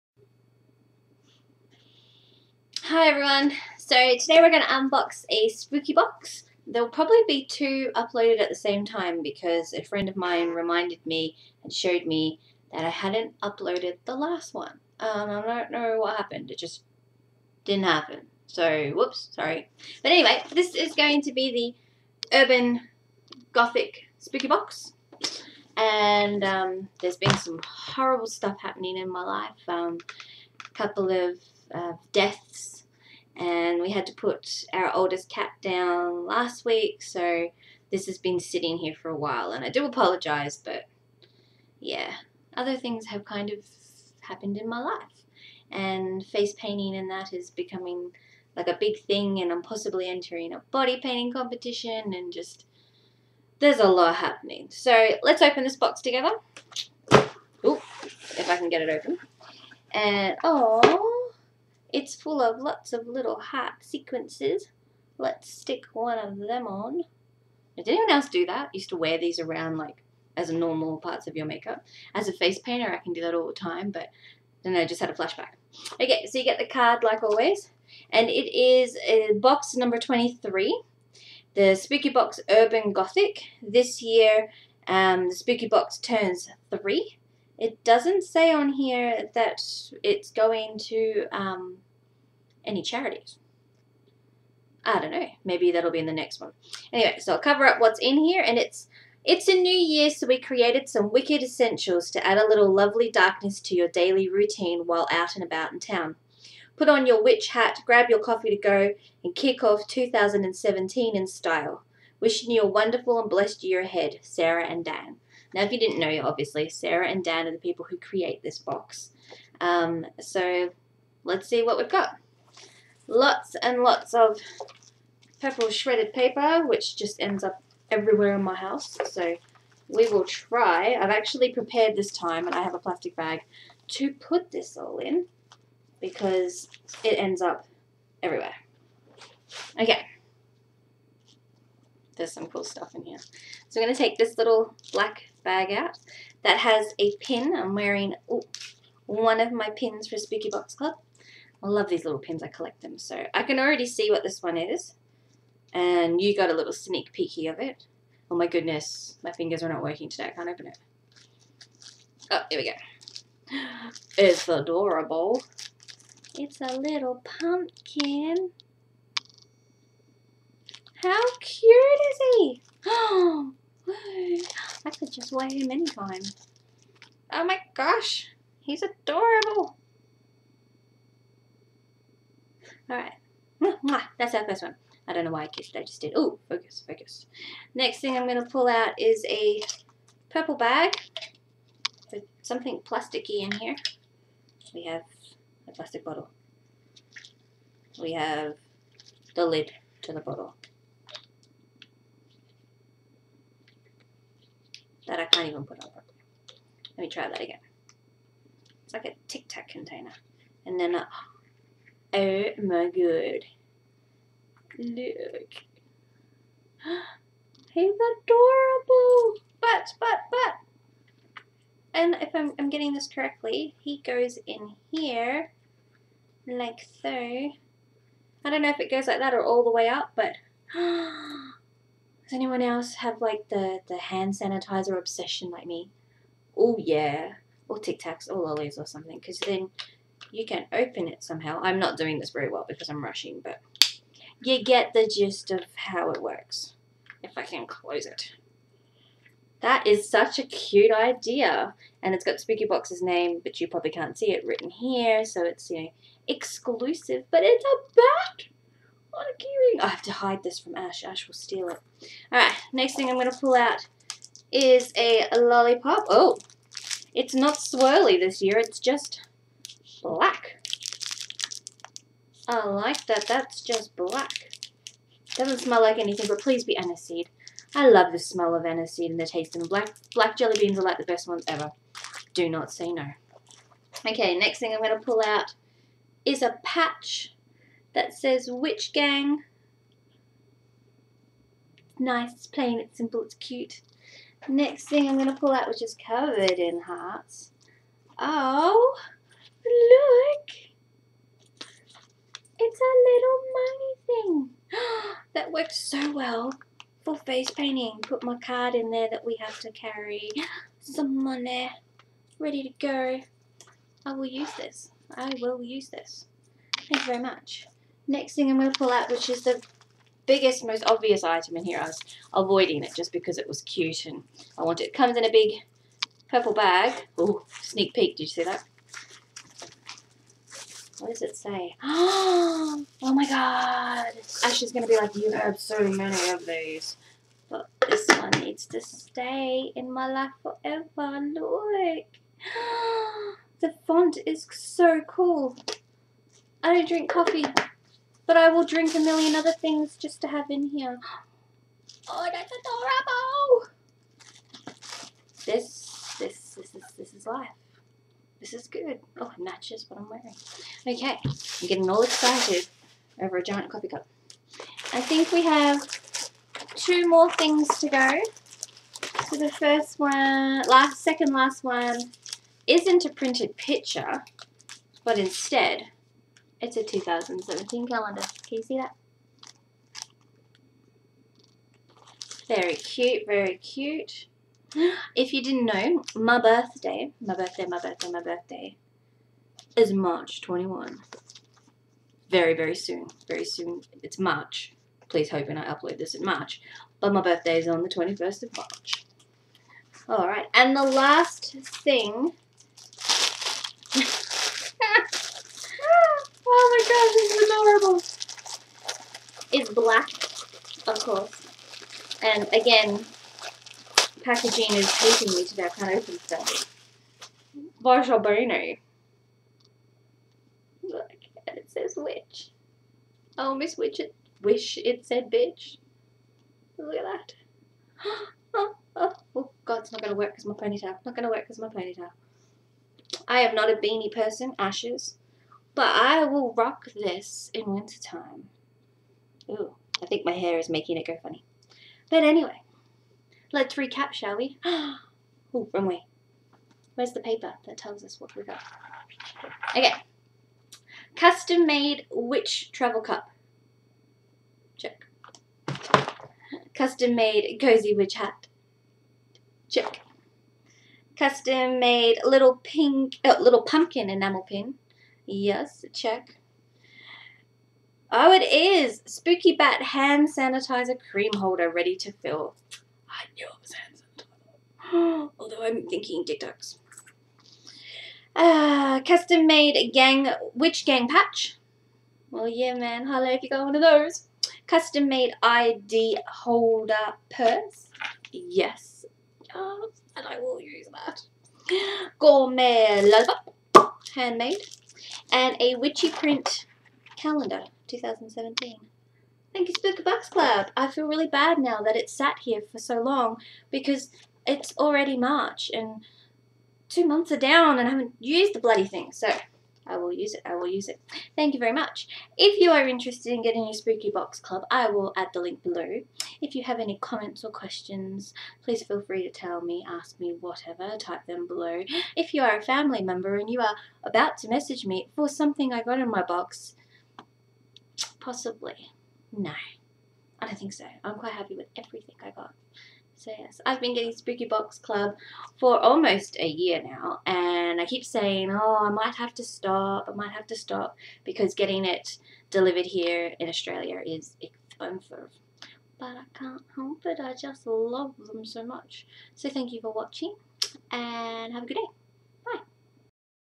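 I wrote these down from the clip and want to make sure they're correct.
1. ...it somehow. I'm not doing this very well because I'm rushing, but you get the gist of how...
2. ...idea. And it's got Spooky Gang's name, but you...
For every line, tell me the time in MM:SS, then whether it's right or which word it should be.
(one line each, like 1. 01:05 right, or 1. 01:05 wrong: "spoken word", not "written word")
1. 04:01 right
2. 04:10 wrong: "Box", not "Gang".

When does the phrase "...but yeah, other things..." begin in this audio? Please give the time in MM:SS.
00:40.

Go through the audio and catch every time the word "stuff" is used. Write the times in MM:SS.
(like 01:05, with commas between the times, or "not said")
00:28, 02:22, 06:56.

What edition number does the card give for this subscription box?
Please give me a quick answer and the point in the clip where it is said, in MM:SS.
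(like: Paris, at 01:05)
23, at 01:19.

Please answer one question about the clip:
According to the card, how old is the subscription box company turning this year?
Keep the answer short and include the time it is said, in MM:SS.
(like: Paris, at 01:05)
3, at 01:25.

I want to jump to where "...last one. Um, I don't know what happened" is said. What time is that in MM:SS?
00:14.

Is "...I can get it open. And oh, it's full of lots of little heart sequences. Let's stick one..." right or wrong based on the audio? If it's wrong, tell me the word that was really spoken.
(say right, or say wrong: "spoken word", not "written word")
right.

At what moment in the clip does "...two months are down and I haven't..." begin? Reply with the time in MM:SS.
08:26.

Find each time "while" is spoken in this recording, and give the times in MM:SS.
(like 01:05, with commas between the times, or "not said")
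00:39, 01:44.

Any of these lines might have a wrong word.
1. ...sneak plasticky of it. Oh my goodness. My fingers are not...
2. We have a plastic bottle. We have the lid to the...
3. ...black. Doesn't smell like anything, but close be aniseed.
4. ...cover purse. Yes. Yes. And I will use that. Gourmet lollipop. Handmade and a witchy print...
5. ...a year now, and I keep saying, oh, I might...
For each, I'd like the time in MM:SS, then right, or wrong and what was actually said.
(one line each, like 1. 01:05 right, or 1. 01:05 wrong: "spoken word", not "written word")
1. 02:36 wrong: "peeky", not "plasticky"
2. 03:14 right
3. 04:33 wrong: "please", not "close"
4. 08:06 wrong: "holder", not "cover"
5. 08:56 right.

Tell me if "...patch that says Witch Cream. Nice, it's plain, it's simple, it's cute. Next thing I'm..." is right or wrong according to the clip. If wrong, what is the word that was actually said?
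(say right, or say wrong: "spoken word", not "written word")
wrong: "Gang", not "Cream".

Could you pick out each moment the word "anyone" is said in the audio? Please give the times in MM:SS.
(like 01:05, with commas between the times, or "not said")
01:07, 03:52.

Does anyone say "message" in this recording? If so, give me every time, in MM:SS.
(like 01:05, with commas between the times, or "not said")
08:44.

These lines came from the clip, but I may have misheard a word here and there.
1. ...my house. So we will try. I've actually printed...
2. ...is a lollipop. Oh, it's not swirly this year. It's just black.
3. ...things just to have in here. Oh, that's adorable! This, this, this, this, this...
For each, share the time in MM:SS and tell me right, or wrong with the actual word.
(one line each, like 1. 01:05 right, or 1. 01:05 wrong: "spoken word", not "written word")
1. 02:08 wrong: "prepared", not "printed"
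2. 04:24 right
3. 05:49 right.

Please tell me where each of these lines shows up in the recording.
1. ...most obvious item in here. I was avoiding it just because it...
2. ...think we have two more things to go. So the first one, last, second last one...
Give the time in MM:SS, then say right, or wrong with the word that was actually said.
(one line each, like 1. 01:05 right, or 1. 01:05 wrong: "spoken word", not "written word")
1. 05:20 right
2. 06:05 right.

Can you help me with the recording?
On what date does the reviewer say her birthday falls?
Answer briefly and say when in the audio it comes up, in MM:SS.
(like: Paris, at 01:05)
March 21, at 06:29.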